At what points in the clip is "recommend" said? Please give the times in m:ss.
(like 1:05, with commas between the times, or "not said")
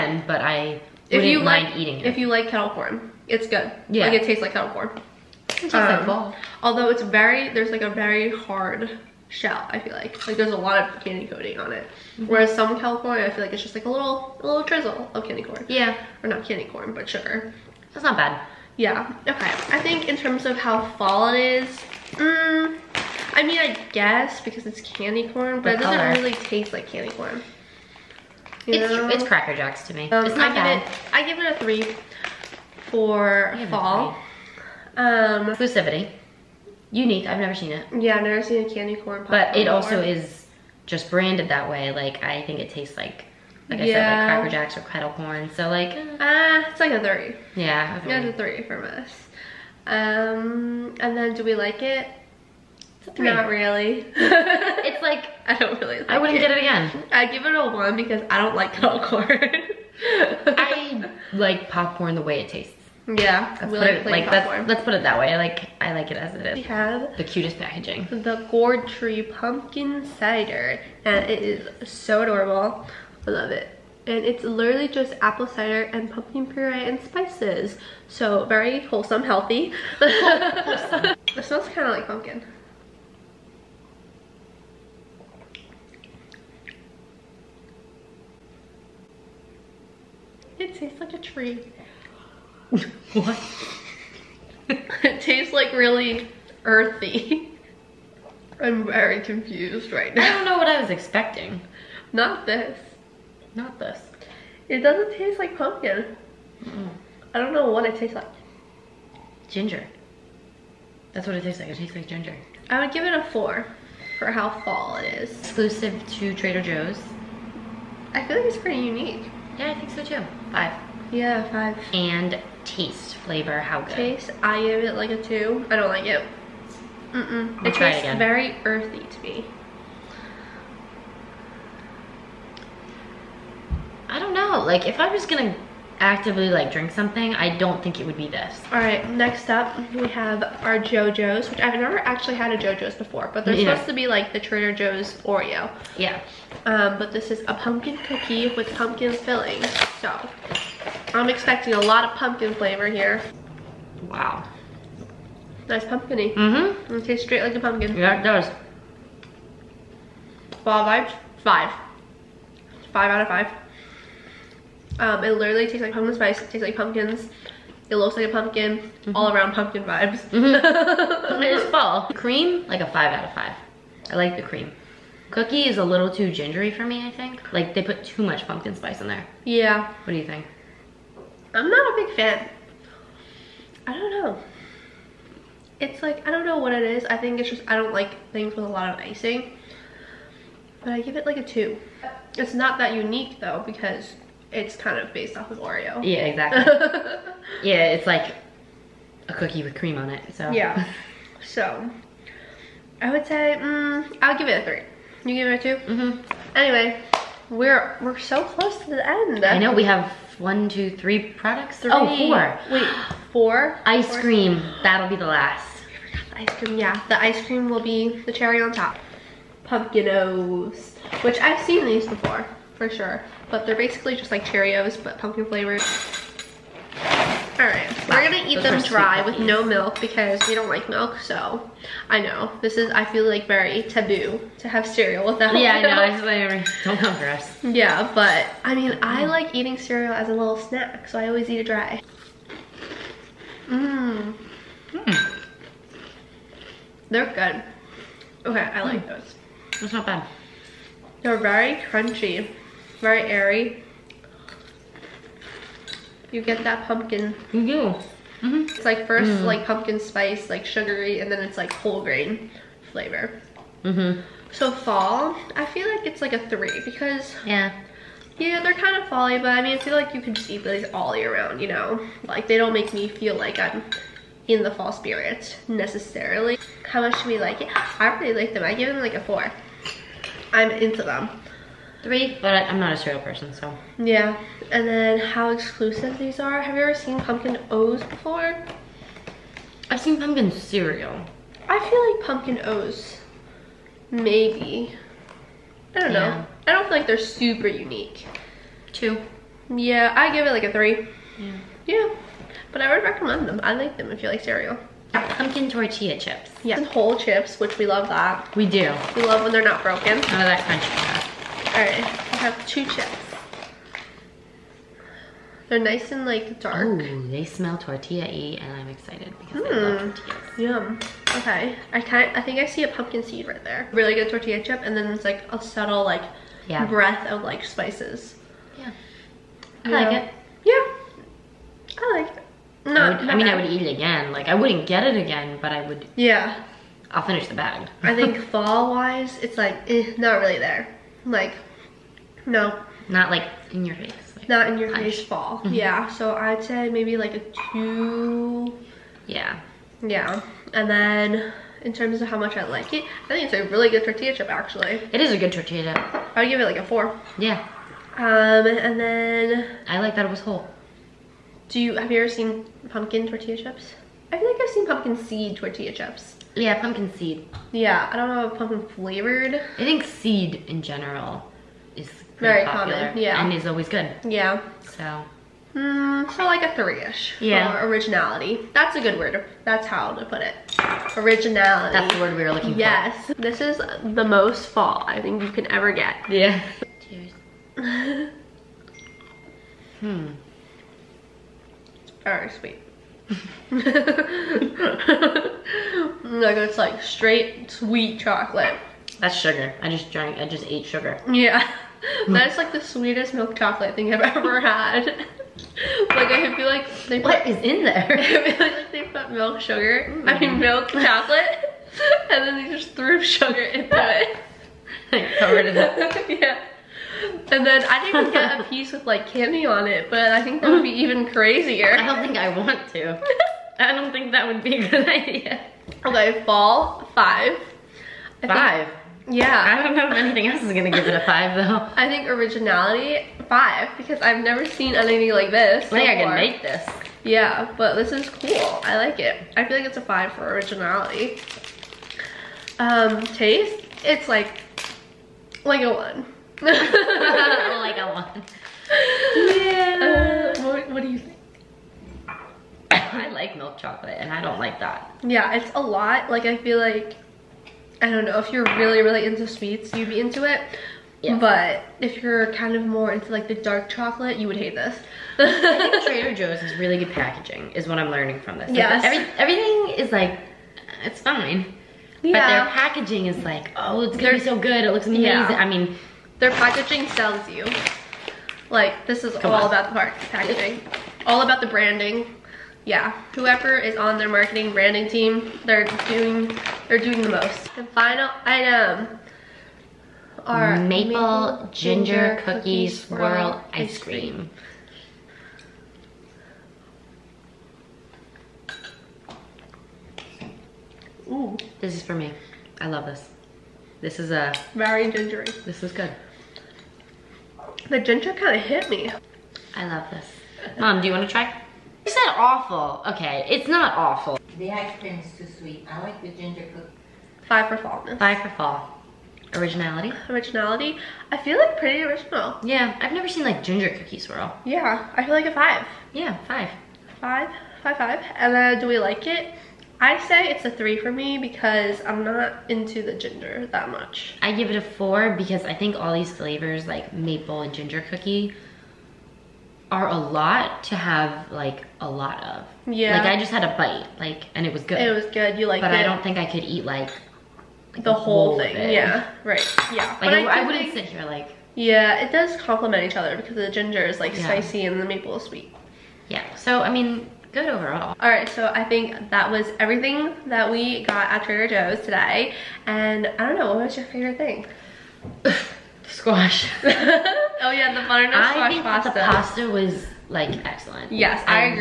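5:03.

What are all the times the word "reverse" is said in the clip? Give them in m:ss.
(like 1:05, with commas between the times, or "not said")
not said.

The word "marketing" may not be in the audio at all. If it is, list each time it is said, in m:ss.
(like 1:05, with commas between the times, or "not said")
8:04.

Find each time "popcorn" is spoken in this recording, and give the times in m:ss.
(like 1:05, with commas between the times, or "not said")
1:01.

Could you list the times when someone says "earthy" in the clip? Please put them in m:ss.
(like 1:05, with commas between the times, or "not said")
1:36, 2:08.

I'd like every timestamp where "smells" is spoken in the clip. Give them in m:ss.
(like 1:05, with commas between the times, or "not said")
1:21, 5:17.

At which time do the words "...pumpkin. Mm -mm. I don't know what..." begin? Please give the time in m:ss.
1:45.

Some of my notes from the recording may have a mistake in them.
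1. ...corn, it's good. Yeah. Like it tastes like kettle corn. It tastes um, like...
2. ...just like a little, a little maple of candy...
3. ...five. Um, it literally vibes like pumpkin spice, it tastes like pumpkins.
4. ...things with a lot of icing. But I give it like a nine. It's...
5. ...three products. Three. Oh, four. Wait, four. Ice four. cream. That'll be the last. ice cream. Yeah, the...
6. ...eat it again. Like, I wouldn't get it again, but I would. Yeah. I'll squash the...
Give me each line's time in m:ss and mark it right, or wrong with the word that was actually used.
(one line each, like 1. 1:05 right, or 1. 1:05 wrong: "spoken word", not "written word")
1. 0:02 right
2. 0:13 wrong: "drizzle", not "maple"
3. 2:43 wrong: "tastes", not "vibes"
4. 3:08 wrong: "two", not "nine"
5. 3:30 right
6. 5:33 wrong: "finish", not "squash".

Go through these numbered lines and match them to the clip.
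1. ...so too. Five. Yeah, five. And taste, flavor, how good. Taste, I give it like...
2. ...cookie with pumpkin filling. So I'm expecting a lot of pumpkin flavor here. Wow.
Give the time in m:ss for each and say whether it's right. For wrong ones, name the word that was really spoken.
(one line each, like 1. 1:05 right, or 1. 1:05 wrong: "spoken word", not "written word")
1. 1:59 right
2. 2:27 right.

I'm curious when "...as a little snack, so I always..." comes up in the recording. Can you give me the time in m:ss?
4:00.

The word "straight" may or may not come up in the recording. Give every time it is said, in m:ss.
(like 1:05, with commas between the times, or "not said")
2:37, 6:37.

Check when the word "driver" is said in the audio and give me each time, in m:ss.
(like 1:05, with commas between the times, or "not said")
not said.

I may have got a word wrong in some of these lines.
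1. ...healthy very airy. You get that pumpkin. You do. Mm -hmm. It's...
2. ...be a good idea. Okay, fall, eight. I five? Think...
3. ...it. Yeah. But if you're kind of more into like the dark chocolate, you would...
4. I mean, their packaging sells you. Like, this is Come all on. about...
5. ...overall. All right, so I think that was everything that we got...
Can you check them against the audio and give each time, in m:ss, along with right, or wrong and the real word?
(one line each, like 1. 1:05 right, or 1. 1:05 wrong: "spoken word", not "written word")
1. 4:11 wrong: "crunchy", not "healthy"
2. 7:04 wrong: "five", not "eight"
3. 7:40 right
4. 7:55 right
5. 9:17 right.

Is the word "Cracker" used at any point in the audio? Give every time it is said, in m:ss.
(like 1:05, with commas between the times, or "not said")
0:29, 0:44.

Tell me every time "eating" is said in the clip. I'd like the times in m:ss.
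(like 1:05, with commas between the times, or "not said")
0:01, 3:59.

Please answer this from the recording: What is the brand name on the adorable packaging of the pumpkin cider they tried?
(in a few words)
Gourd Tree.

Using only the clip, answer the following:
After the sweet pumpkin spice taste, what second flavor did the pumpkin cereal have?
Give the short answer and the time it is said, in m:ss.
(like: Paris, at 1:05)
whole grain, at 4:21.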